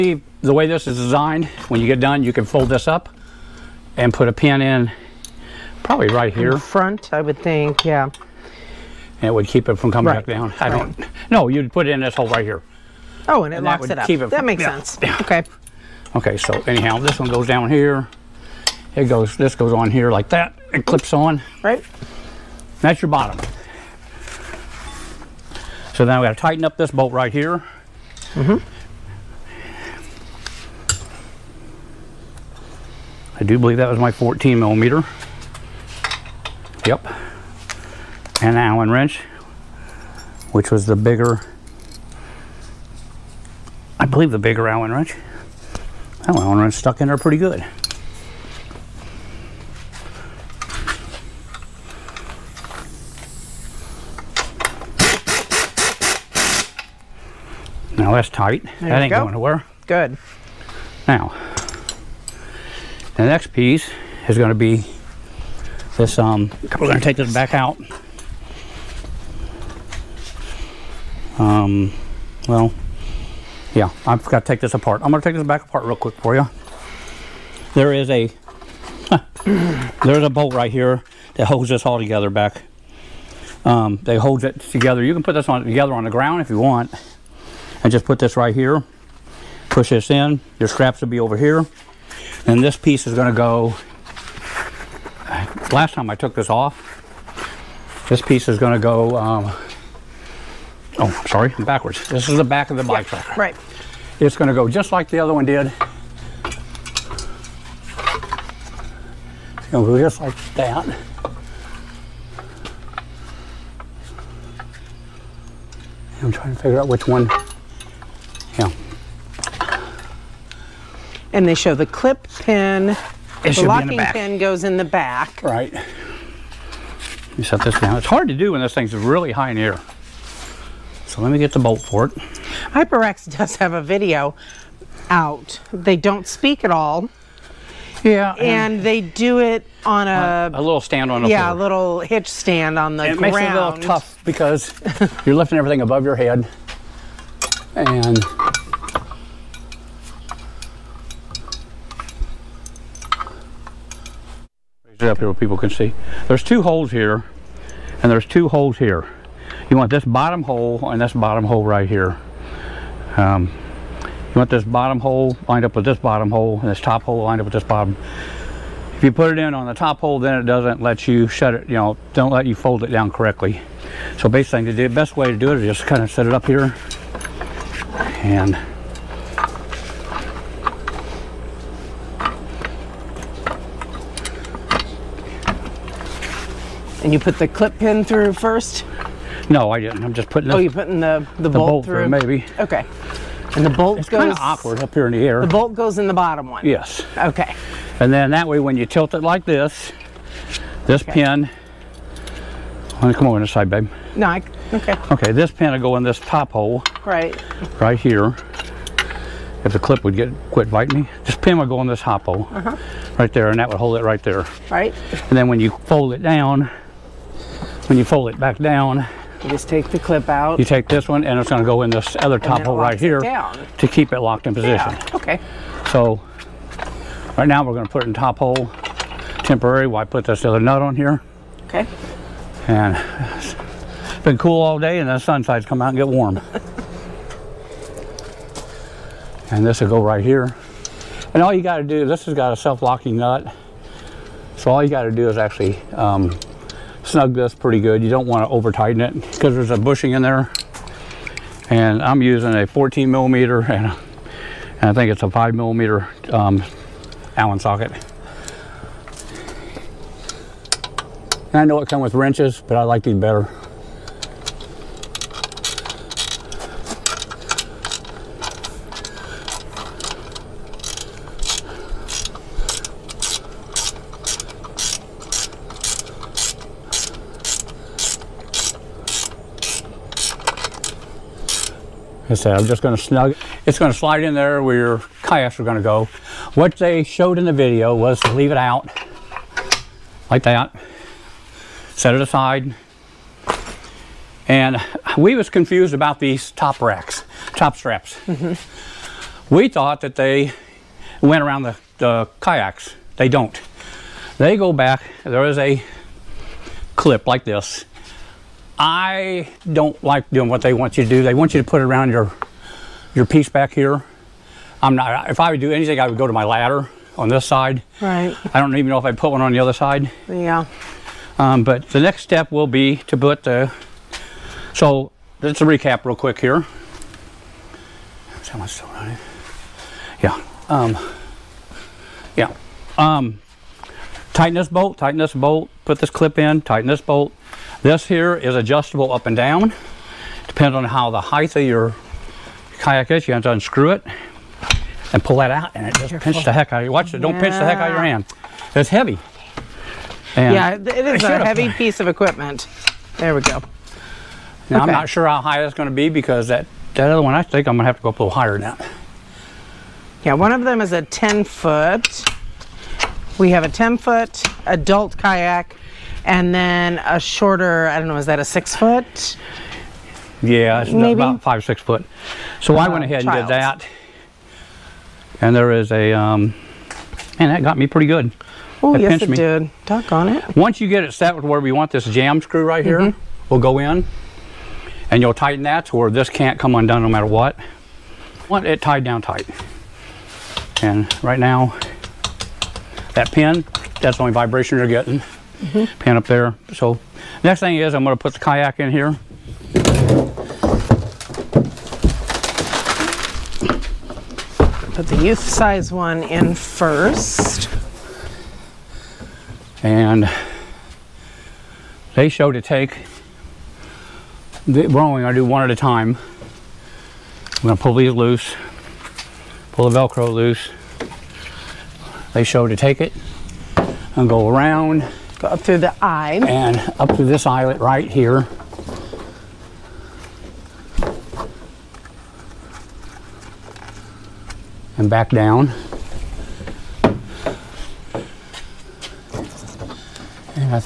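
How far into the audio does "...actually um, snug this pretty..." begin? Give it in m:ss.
4:05.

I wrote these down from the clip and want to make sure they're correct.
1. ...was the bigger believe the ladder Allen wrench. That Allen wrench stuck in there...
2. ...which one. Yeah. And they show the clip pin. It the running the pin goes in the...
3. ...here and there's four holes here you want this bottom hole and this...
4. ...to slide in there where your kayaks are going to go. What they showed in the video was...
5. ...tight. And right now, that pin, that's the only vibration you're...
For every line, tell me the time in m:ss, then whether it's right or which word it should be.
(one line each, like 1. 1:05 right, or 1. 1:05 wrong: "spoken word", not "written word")
1. 0:40 wrong: "bigger", not "ladder"
2. 1:56 wrong: "locking", not "running"
3. 2:36 wrong: "two", not "four"
4. 4:43 right
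5. 6:29 right.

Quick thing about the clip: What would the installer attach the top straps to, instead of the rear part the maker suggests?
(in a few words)
ladder.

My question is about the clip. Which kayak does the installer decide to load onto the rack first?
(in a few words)
youth size one.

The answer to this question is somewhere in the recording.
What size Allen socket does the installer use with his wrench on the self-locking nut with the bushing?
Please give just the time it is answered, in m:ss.
4:15.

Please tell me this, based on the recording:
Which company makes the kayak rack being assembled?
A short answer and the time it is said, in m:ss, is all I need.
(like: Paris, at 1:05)
Hyperax, at 2:12.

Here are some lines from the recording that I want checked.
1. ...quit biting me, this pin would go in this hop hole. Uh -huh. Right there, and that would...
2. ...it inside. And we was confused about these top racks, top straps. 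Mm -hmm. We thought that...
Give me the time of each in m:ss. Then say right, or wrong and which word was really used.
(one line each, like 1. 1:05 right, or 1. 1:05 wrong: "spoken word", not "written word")
1. 3:30 right
2. 4:52 wrong: "aside", not "inside".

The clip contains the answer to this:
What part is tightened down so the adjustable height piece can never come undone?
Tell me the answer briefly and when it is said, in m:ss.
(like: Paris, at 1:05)
jam screw, at 6:22.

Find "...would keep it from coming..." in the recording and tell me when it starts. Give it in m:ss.
0:09.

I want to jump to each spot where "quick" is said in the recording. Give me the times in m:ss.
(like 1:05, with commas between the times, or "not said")
1:15, 5:26.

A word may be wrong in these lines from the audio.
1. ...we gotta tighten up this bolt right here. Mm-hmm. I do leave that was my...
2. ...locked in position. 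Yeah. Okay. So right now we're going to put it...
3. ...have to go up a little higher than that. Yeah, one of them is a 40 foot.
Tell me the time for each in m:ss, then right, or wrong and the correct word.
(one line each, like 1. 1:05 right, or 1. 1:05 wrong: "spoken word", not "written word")
1. 0:26 wrong: "believe", not "leave"
2. 3:44 right
3. 5:57 wrong: "10", not "40".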